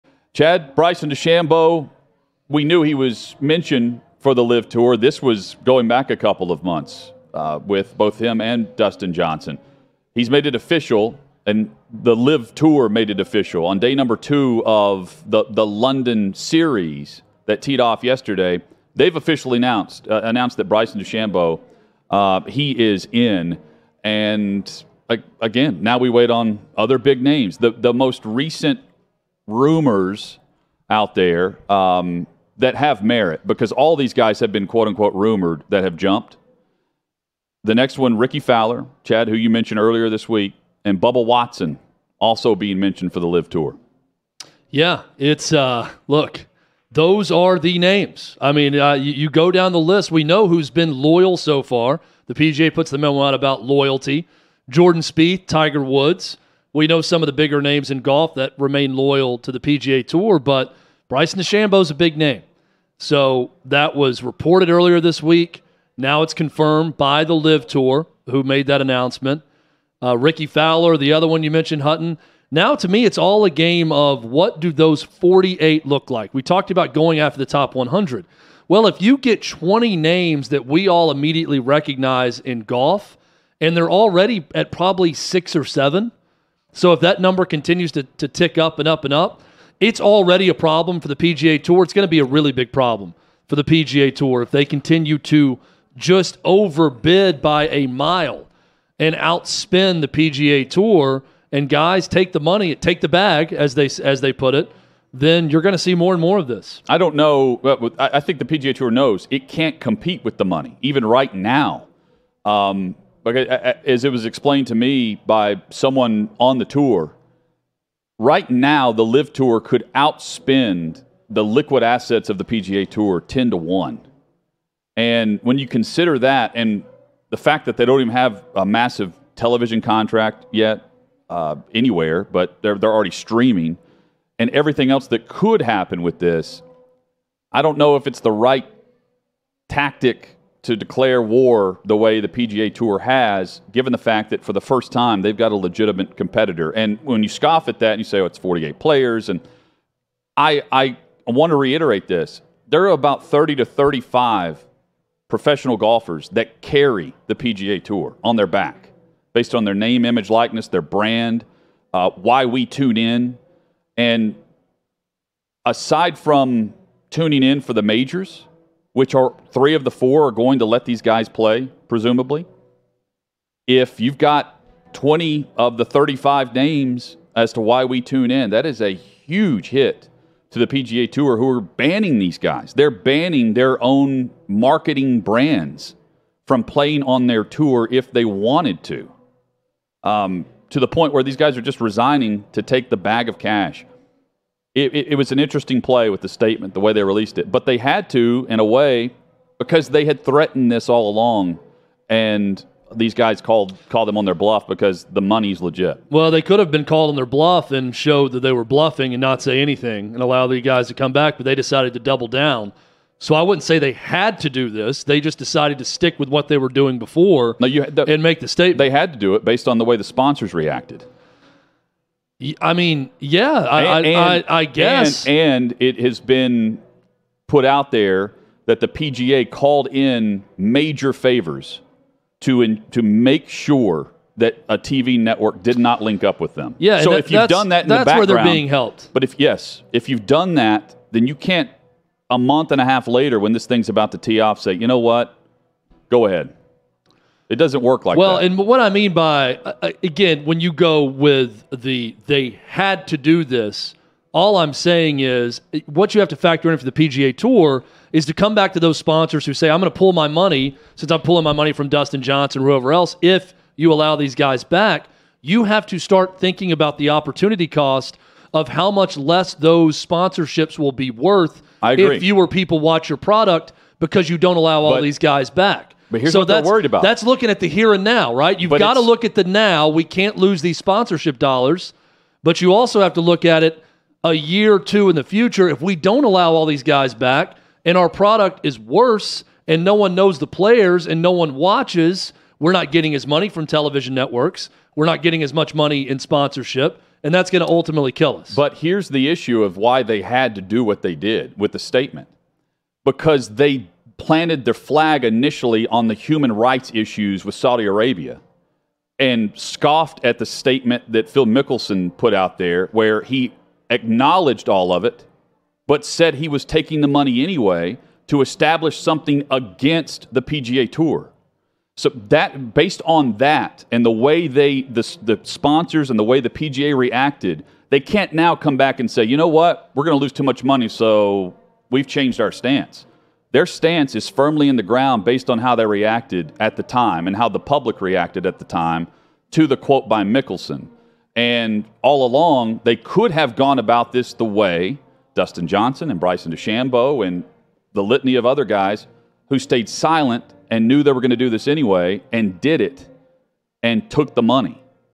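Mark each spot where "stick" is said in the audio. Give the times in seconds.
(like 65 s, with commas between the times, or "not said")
215 s.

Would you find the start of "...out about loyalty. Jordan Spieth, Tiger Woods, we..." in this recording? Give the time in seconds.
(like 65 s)
53 s.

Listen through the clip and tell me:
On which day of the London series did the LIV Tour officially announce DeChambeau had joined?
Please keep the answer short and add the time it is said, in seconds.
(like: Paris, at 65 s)
Day 2, at 13 s.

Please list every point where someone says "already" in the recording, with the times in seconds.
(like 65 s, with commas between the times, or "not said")
83 s, 89 s, 132 s.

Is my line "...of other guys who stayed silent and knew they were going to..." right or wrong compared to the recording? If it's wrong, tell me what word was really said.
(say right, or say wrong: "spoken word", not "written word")
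right.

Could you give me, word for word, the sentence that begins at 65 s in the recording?
Now it's confirmed by the LIV Tour, who made that announcement.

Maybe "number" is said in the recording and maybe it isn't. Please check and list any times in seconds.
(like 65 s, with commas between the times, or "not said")
13 s, 87 s.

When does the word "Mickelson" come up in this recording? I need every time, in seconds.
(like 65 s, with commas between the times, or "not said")
311 s, 340 s.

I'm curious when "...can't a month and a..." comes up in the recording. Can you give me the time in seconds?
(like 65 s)
241 s.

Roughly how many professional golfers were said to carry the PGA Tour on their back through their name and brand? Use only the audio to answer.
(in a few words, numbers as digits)
30 to 35.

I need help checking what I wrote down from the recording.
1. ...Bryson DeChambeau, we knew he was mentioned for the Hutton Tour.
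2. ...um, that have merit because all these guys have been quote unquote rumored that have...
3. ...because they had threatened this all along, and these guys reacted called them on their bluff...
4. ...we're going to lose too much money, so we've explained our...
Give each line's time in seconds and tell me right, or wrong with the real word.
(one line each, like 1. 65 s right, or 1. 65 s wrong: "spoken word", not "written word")
1. 0 s wrong: "LIV", not "Hutton"
2. 31 s right
3. 199 s wrong: "called", not "reacted"
4. 329 s wrong: "changed", not "explained".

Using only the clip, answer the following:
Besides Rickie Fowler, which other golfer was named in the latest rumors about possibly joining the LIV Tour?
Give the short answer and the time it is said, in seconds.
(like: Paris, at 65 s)
Bubba Watson, at 40 s.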